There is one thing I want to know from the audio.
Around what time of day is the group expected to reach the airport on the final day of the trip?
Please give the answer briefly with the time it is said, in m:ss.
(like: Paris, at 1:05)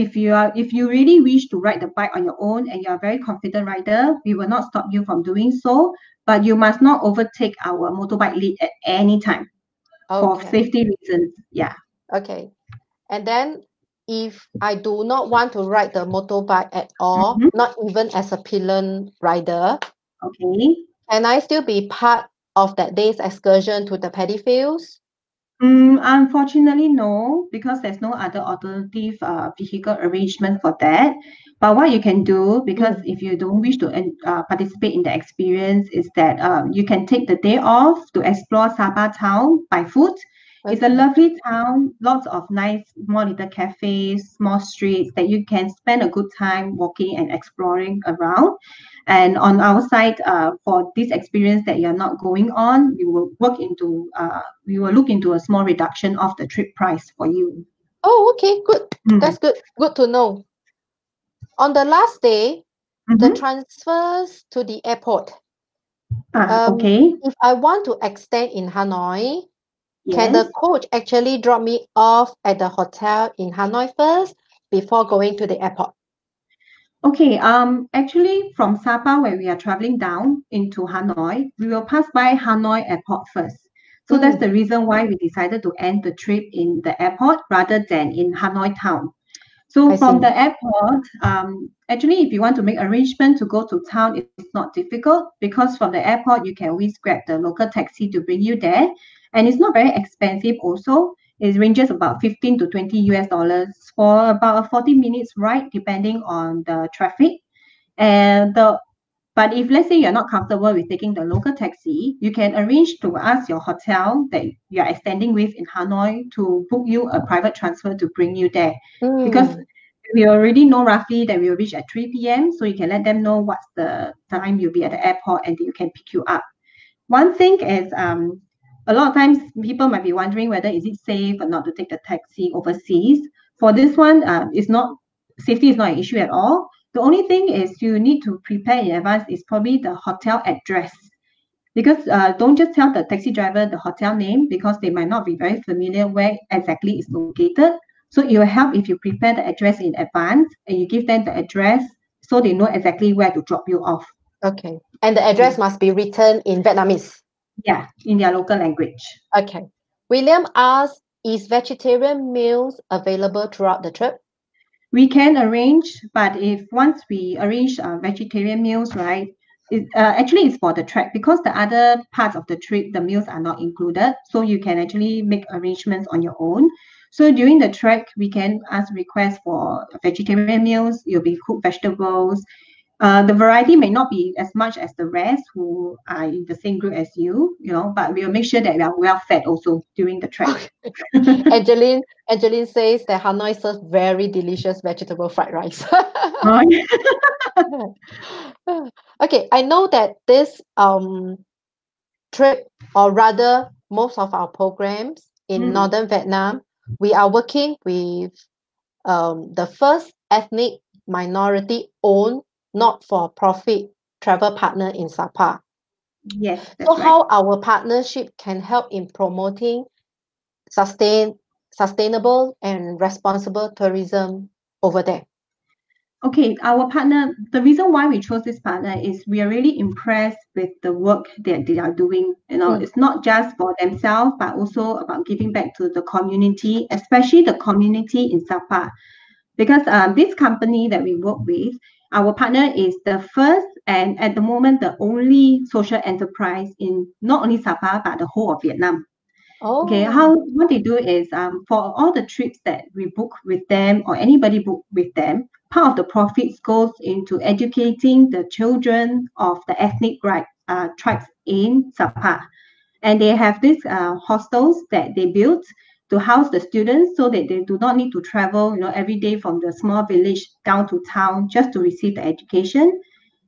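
3 p.m., at 2:01.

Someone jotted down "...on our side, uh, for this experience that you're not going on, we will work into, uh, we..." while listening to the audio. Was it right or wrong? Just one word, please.
right.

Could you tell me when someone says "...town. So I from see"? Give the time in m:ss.
1:28.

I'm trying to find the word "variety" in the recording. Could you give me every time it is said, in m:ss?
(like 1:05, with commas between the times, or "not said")
3:03.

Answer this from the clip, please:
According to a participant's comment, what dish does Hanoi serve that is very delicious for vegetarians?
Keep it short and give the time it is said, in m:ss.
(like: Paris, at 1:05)
Vegetable fried rice, at 3:14.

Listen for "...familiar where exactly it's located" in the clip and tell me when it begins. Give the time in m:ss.
2:25.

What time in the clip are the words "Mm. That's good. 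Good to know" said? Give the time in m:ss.
0:59.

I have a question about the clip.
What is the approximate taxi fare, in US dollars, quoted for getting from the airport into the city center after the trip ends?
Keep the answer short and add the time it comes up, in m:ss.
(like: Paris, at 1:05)
15 to 20 US dollars, at 1:42.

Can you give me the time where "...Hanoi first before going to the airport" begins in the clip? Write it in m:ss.
1:13.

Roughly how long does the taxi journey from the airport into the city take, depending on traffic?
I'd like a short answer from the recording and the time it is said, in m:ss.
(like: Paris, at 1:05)
40 minutes, at 1:44.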